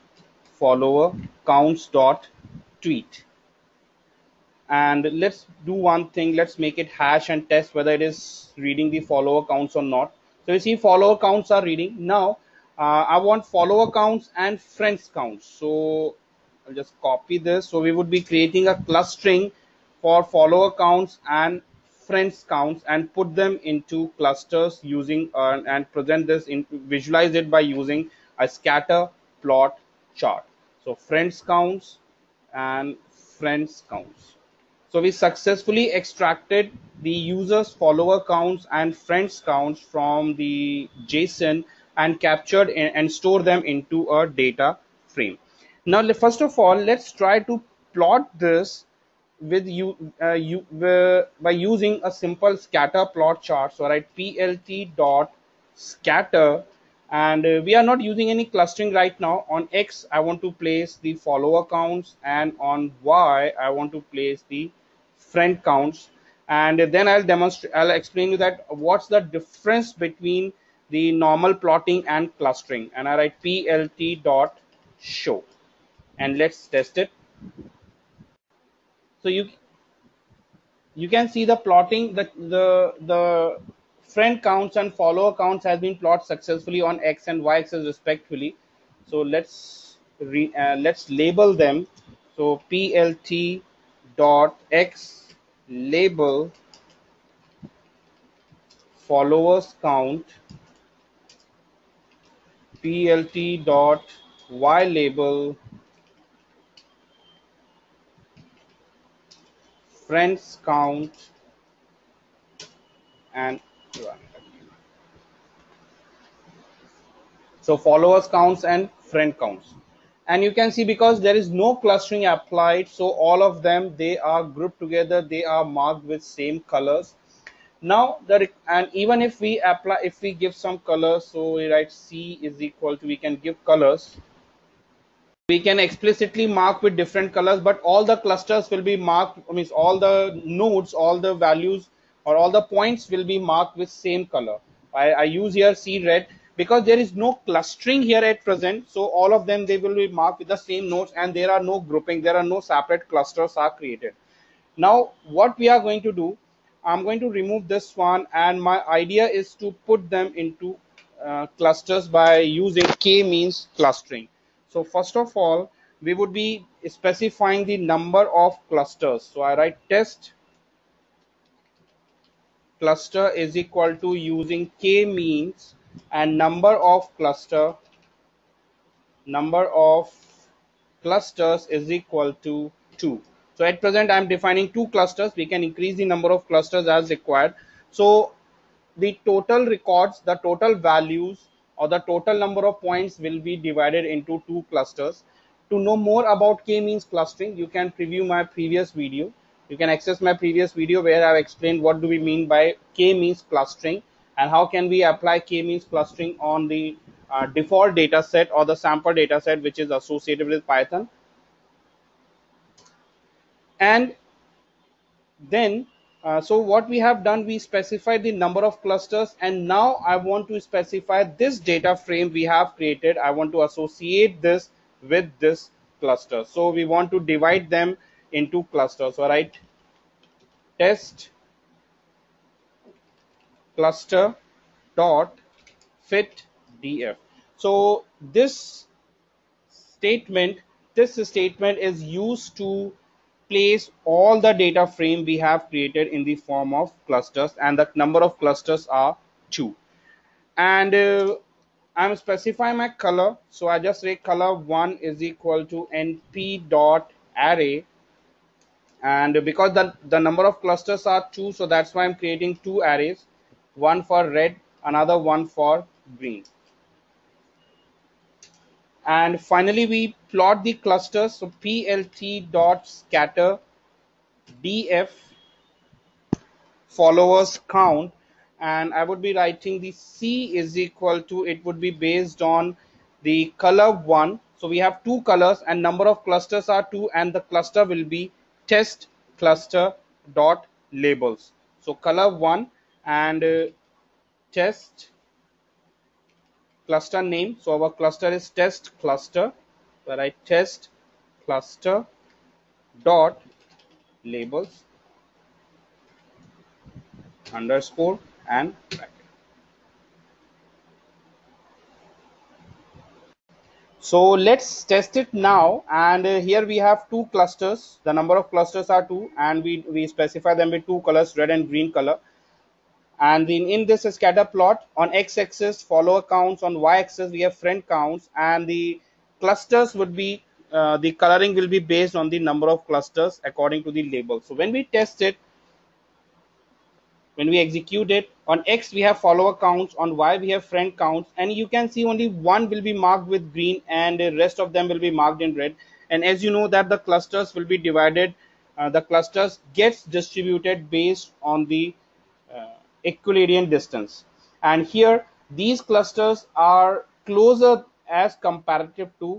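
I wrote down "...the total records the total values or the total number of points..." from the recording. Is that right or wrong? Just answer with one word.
right.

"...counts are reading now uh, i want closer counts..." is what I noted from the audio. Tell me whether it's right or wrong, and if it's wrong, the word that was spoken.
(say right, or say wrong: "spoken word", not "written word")
wrong: "follower", not "closer".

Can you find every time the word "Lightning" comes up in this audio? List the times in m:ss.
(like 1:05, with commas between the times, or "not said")
not said.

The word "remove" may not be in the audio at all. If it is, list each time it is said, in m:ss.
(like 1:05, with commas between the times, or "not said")
2:37.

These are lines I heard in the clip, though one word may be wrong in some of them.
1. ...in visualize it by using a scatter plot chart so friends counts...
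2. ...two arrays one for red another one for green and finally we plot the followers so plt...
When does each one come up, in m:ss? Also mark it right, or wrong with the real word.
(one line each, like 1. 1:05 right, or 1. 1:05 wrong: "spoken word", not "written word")
1. 0:26 right
2. 4:22 wrong: "clusters", not "followers".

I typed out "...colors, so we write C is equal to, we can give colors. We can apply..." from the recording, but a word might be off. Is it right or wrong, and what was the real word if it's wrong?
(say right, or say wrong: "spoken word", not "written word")
wrong: "explicitly", not "apply".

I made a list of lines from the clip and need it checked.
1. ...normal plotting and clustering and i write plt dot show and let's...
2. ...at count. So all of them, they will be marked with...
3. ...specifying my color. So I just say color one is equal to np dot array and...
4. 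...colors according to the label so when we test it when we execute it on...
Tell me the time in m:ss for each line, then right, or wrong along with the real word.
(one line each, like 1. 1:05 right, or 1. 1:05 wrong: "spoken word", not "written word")
1. 1:11 right
2. 2:28 wrong: "present", not "count"
3. 4:12 right
4. 5:32 wrong: "clusters", not "colors".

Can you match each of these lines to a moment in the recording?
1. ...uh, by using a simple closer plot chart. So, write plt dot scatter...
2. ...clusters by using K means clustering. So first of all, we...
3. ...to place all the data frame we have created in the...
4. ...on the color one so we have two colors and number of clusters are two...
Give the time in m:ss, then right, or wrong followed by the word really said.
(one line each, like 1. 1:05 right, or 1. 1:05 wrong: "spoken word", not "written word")
1. 0:50 wrong: "scatter", not "closer"
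2. 2:41 right
3. 4:02 right
4. 4:42 right.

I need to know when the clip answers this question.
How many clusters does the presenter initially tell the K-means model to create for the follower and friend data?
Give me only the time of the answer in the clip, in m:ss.
3:02.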